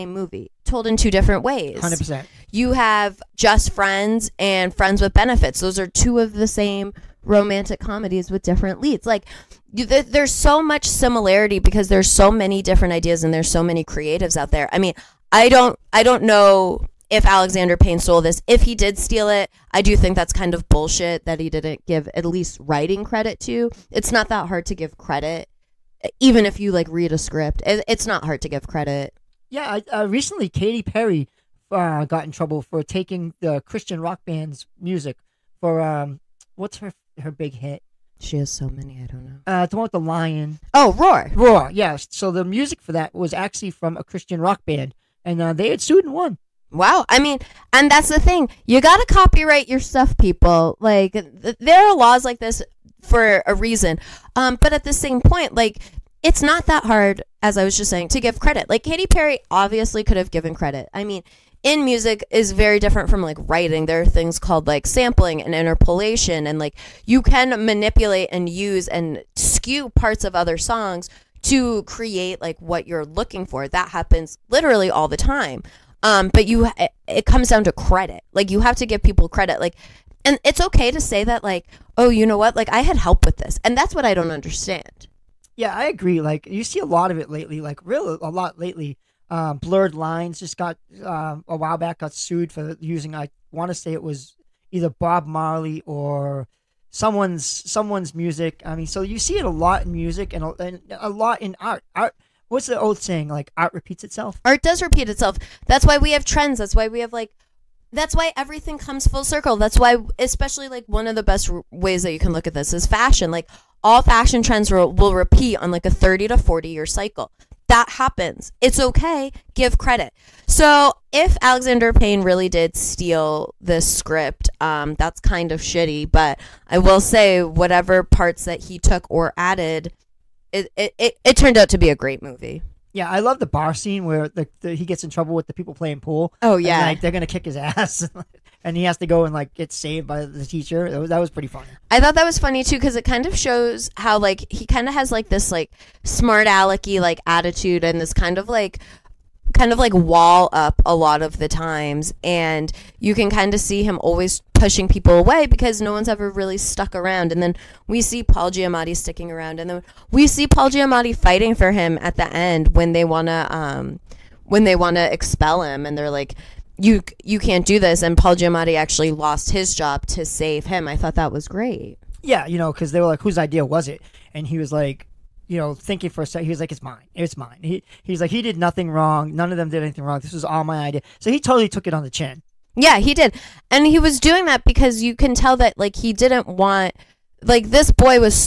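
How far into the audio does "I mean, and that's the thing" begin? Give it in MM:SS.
00:47.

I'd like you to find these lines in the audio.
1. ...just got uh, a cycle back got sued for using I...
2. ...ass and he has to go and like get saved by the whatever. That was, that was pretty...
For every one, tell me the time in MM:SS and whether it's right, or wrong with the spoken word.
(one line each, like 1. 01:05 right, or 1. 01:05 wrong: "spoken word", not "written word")
1. 01:30 wrong: "while", not "cycle"
2. 02:17 wrong: "teacher", not "whatever".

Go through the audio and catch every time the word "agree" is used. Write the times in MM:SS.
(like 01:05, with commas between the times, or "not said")
01:25.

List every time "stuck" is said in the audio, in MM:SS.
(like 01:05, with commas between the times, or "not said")
02:36.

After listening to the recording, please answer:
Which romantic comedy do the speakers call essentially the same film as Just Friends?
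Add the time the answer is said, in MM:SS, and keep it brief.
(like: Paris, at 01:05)
Friends with Benefits, at 00:04.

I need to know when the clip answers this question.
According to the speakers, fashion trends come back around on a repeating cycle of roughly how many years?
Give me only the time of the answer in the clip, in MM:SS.
01:55.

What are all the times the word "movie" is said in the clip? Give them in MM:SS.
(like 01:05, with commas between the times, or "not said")
00:00, 02:12.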